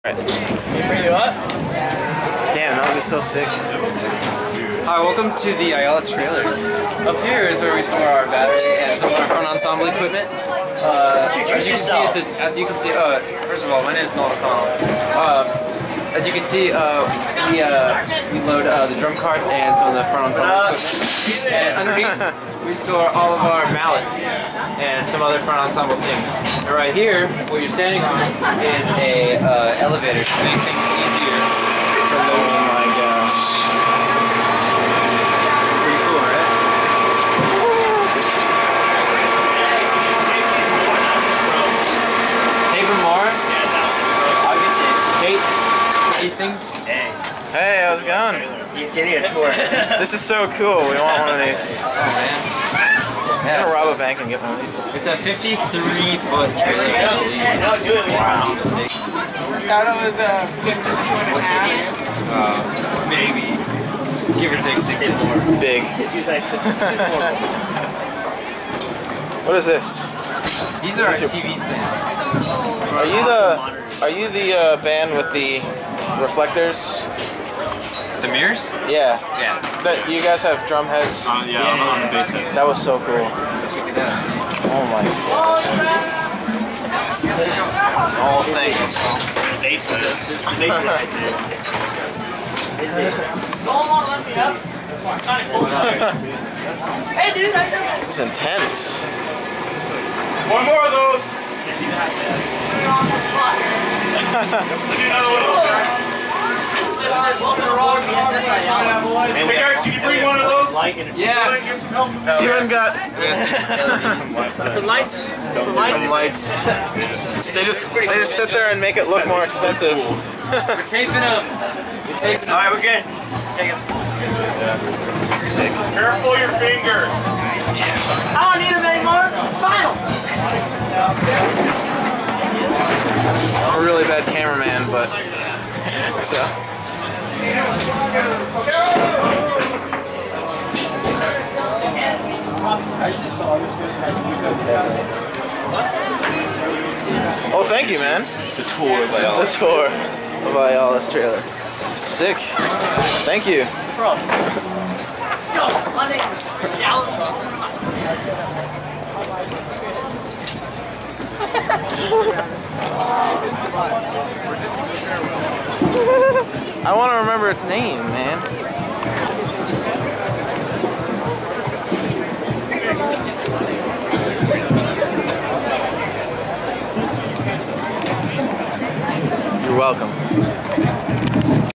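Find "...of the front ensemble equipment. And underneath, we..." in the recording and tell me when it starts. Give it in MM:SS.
00:19.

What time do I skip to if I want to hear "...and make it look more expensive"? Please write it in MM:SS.
01:58.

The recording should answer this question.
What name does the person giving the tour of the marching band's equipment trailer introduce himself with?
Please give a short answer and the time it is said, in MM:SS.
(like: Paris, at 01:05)
Nolan Connell, at 00:14.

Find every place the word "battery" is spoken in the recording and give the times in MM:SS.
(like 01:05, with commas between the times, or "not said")
00:08.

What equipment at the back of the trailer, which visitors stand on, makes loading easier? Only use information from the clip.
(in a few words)
elevator.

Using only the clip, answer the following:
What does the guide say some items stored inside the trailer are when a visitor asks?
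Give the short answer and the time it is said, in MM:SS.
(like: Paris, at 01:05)
TV stands, at 01:11.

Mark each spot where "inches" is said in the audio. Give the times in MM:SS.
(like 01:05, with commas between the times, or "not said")
01:05.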